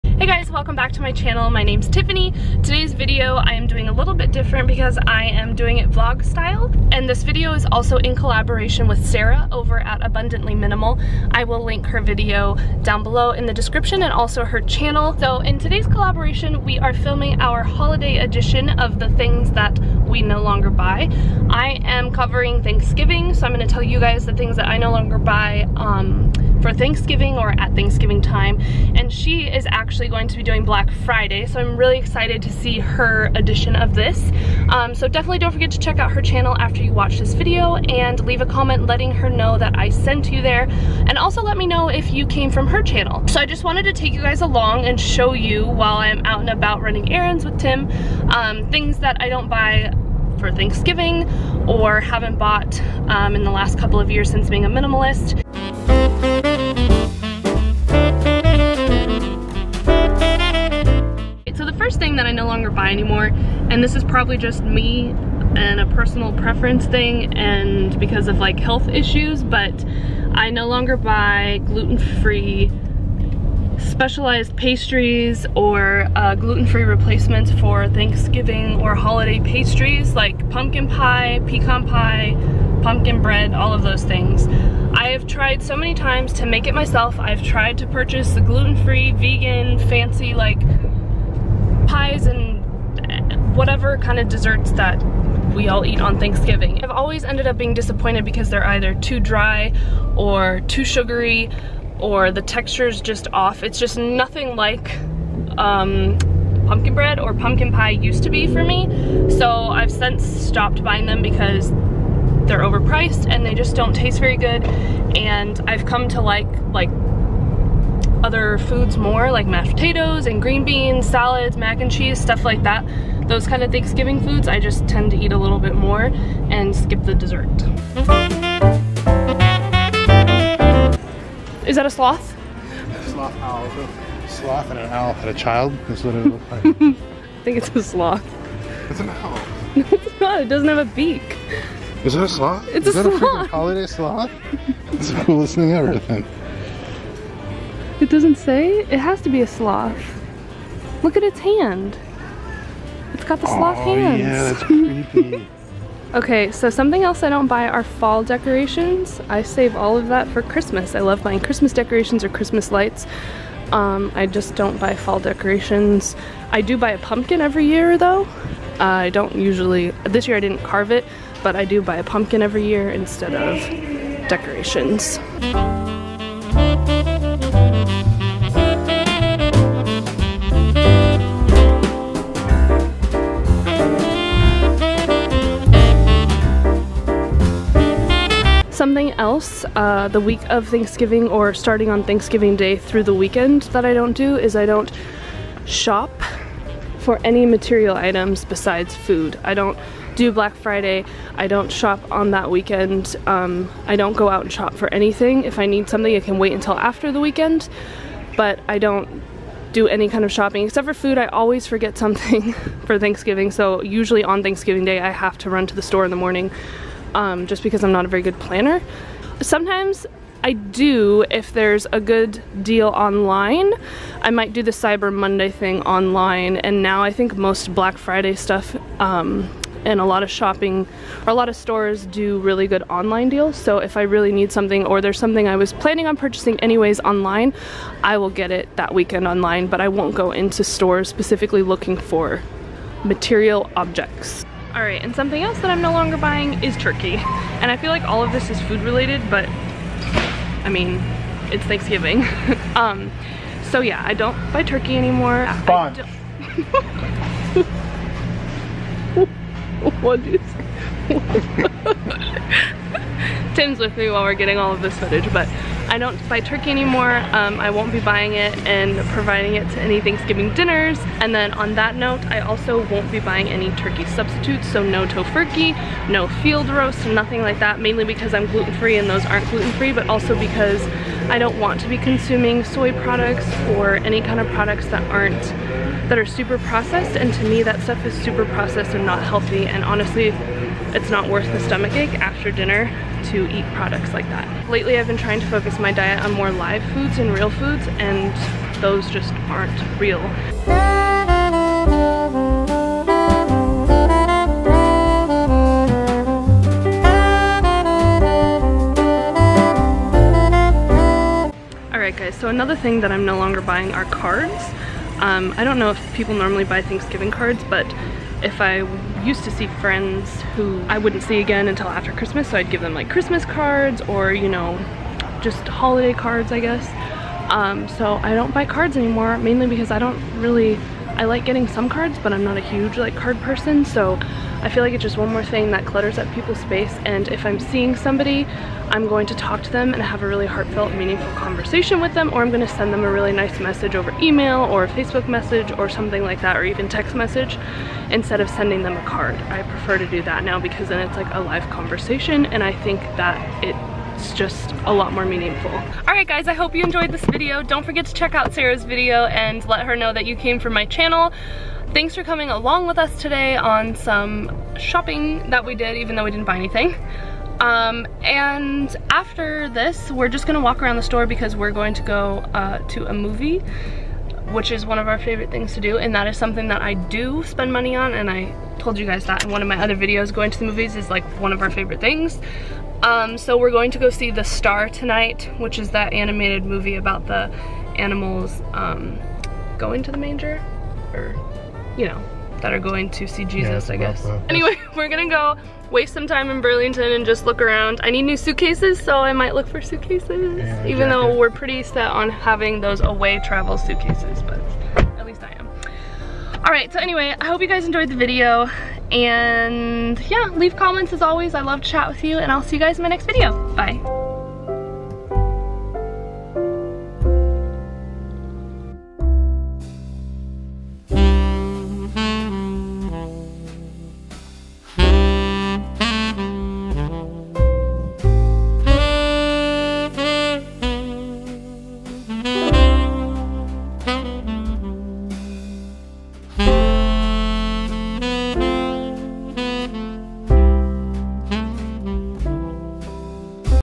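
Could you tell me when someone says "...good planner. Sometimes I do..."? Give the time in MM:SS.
03:38.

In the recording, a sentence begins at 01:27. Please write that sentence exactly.
I've tried to purchase the gluten-free, vegan, fancy like pies and whatever kind of desserts that we all eat on Thanksgiving.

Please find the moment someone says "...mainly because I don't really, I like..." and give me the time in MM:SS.
05:29.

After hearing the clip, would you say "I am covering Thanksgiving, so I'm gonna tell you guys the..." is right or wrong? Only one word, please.
right.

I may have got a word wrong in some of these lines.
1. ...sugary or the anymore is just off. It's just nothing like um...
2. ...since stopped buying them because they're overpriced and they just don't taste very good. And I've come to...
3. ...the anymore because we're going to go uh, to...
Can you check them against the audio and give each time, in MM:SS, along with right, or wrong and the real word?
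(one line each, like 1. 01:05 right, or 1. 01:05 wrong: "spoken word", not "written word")
1. 01:40 wrong: "texture", not "anymore"
2. 01:49 right
3. 06:10 wrong: "store", not "anymore".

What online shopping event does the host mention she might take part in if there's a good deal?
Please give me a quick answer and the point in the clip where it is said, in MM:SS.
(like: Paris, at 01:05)
Cyber Monday, at 03:44.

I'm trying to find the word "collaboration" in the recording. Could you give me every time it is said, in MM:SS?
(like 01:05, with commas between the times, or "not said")
00:08, 00:15.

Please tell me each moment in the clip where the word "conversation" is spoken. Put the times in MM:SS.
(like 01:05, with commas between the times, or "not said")
05:41, 05:51.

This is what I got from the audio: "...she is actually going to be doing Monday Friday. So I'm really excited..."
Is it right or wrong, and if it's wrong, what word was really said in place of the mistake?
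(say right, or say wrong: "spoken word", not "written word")
wrong: "Black", not "Monday".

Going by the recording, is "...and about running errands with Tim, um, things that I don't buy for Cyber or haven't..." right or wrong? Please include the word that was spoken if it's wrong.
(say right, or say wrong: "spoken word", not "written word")
wrong: "Thanksgiving", not "Cyber".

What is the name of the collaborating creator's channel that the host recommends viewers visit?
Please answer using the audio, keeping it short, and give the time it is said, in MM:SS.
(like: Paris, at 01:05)
Abundantly Minimal, at 00:10.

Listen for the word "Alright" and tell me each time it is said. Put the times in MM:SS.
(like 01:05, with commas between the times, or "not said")
05:11.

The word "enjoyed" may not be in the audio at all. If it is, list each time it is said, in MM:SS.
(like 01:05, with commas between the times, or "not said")
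05:56, 06:47.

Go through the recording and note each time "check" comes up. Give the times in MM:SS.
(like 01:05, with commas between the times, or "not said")
00:35, 05:58.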